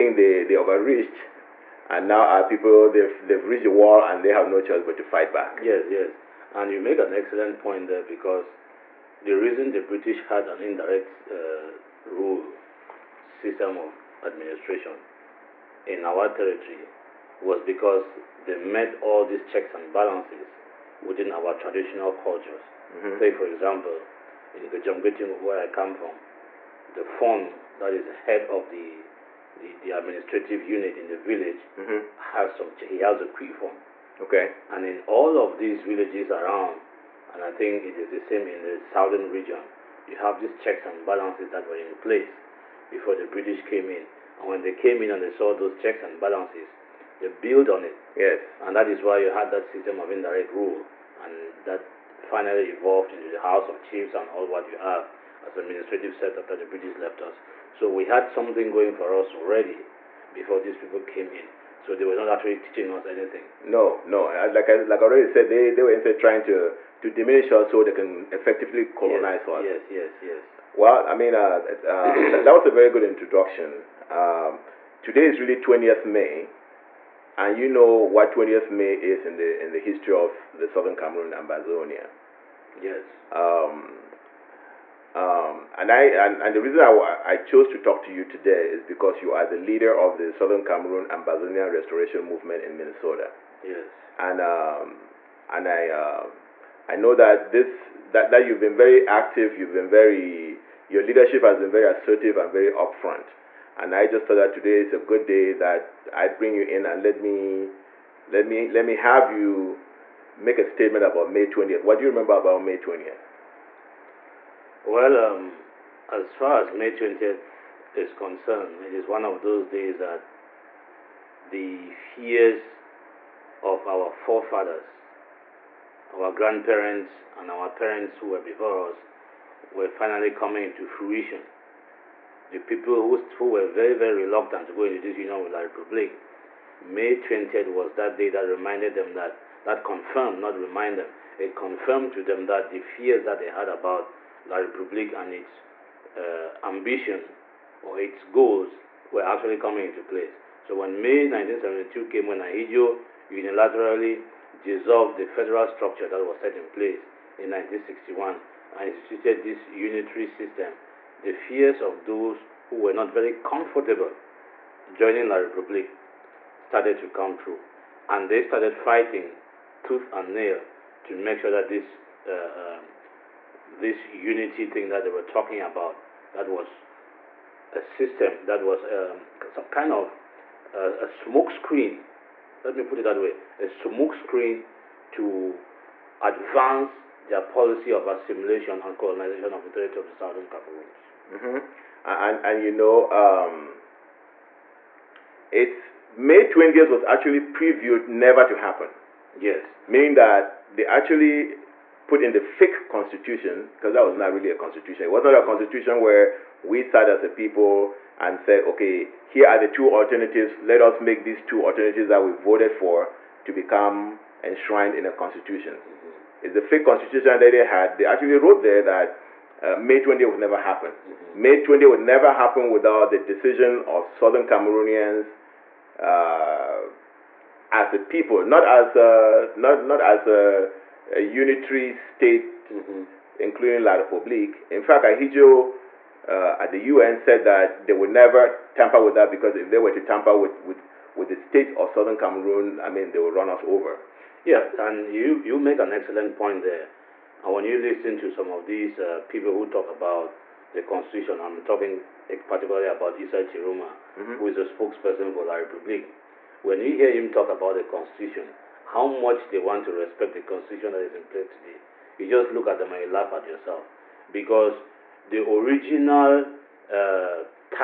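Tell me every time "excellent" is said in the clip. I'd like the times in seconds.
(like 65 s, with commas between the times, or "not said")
7 s, 245 s.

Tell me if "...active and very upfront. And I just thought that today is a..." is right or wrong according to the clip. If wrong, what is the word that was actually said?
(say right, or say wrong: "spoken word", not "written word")
wrong: "assertive", not "active".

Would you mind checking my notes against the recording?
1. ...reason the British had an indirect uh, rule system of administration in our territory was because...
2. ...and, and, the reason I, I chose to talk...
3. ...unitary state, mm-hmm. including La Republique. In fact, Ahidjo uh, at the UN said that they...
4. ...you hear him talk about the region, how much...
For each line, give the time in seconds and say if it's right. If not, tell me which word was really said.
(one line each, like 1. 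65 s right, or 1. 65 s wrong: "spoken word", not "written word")
1. 9 s right
2. 86 s right
3. 231 s right
4. 256 s wrong: "constitution", not "region".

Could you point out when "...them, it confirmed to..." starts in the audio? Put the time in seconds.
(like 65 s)
140 s.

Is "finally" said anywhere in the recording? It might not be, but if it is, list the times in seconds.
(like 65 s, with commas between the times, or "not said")
52 s, 129 s.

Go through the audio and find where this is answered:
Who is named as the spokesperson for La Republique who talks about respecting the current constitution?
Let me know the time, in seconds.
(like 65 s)
253 s.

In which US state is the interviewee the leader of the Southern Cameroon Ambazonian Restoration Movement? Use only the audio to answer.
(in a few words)
Minnesota.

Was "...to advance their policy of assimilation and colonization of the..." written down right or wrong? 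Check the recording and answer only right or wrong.
right.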